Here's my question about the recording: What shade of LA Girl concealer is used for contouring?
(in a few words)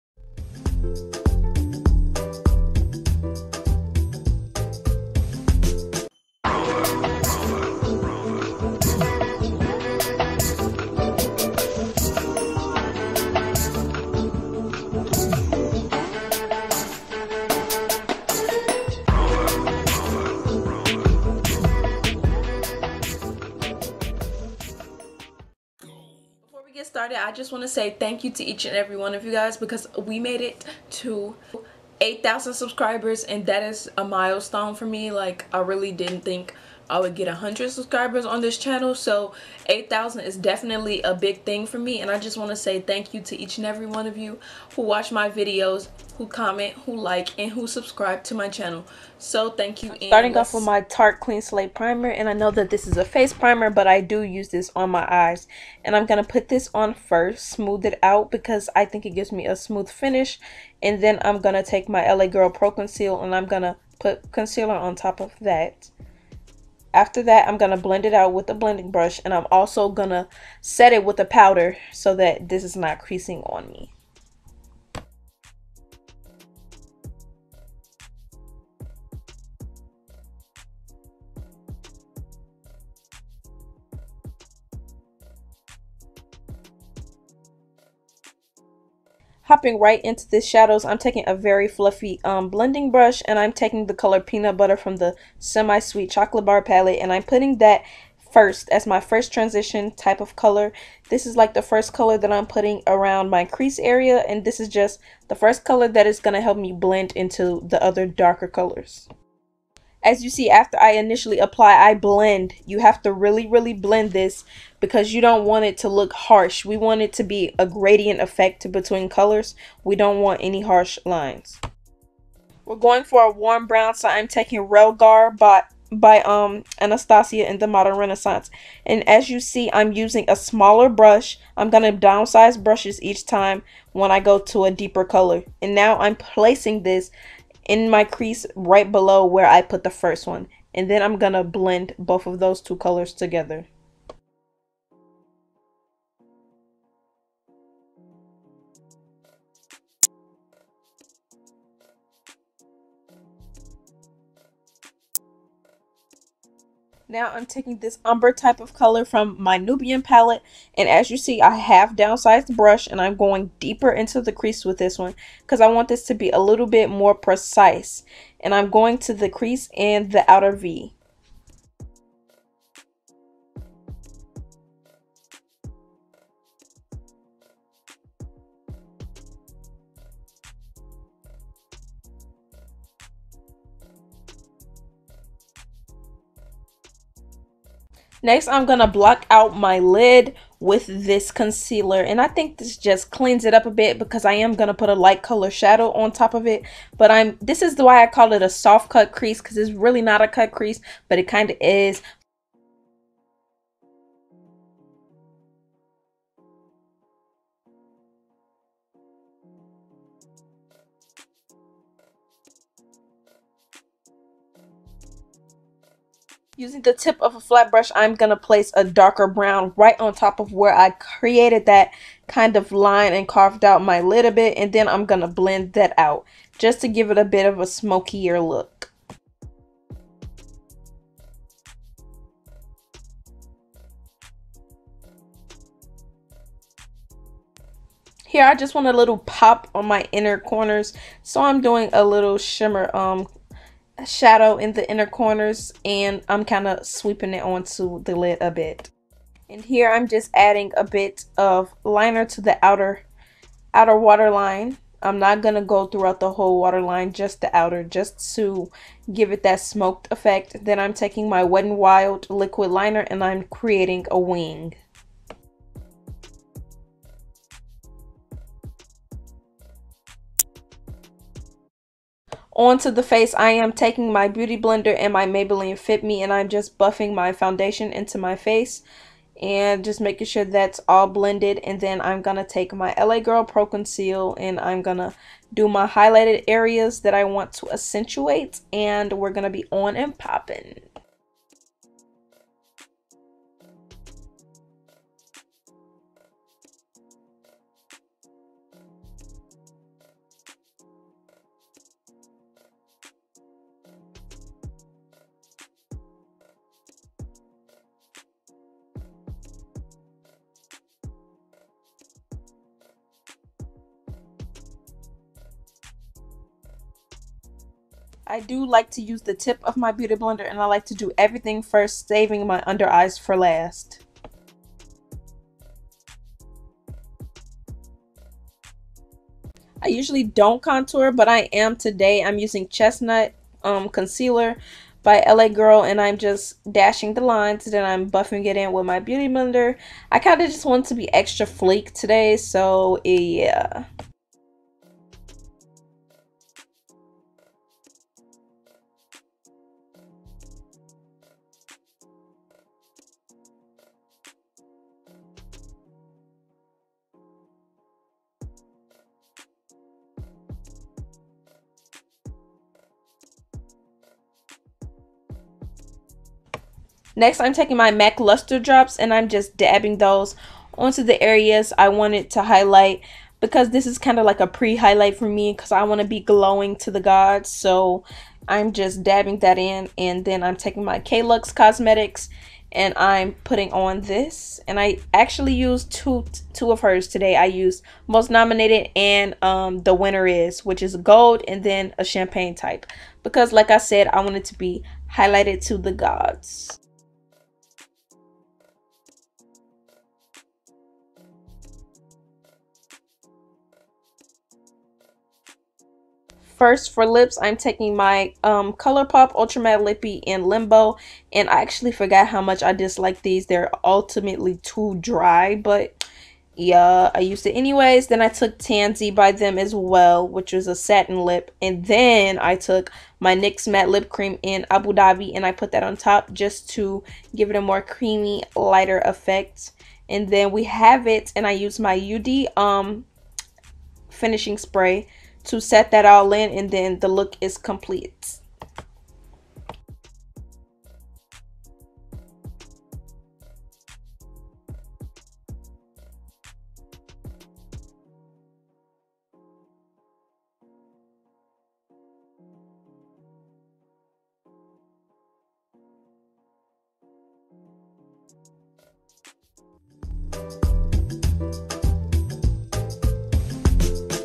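Chestnut.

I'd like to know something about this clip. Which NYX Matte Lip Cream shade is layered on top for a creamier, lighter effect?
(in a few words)
Abu Dhabi.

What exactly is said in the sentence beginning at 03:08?
Next, I'm going to block out my lid with this concealer.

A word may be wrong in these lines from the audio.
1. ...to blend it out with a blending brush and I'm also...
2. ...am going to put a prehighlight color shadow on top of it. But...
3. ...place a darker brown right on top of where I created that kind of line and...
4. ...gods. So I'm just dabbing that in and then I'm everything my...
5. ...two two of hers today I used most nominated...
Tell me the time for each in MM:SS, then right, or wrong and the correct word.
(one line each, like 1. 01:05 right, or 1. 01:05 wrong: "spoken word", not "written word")
1. 01:07 right
2. 03:14 wrong: "light", not "prehighlight"
3. 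03:38 right
4. 06:17 wrong: "taking", not "everything"
5. 06:25 right.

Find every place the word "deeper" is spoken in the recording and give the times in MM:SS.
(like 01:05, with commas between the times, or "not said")
02:14, 02:43.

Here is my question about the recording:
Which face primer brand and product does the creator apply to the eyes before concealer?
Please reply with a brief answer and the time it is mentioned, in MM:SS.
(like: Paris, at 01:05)
Tarte Clean Slate Primer, at 00:50.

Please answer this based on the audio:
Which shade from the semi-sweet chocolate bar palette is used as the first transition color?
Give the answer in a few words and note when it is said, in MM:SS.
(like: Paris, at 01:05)
Peanut Butter, at 01:34.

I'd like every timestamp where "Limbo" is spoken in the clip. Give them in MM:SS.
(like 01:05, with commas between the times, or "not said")
06:50.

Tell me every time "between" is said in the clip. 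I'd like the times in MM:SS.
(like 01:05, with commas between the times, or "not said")
01:58.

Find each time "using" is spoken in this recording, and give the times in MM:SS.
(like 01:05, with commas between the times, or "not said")
02:09, 03:36, 05:32.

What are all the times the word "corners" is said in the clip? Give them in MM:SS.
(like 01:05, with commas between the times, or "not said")
04:00, 04:05.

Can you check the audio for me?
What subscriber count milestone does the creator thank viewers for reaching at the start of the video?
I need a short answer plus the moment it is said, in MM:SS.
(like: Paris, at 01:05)
8,000, at 00:32.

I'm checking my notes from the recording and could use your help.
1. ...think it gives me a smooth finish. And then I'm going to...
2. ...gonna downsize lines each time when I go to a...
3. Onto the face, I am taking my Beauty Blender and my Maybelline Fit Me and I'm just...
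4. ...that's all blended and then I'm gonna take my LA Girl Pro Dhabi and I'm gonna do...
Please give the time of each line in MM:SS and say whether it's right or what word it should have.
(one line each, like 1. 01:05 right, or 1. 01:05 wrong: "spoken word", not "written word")
1. 00:58 right
2. 02:11 wrong: "brushes", not "lines"
3. 04:32 right
4. 04:40 wrong: "Conceal", not "Dhabi".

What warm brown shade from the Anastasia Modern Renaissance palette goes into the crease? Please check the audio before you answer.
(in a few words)
Realgar.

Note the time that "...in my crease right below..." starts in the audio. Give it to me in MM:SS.
02:17.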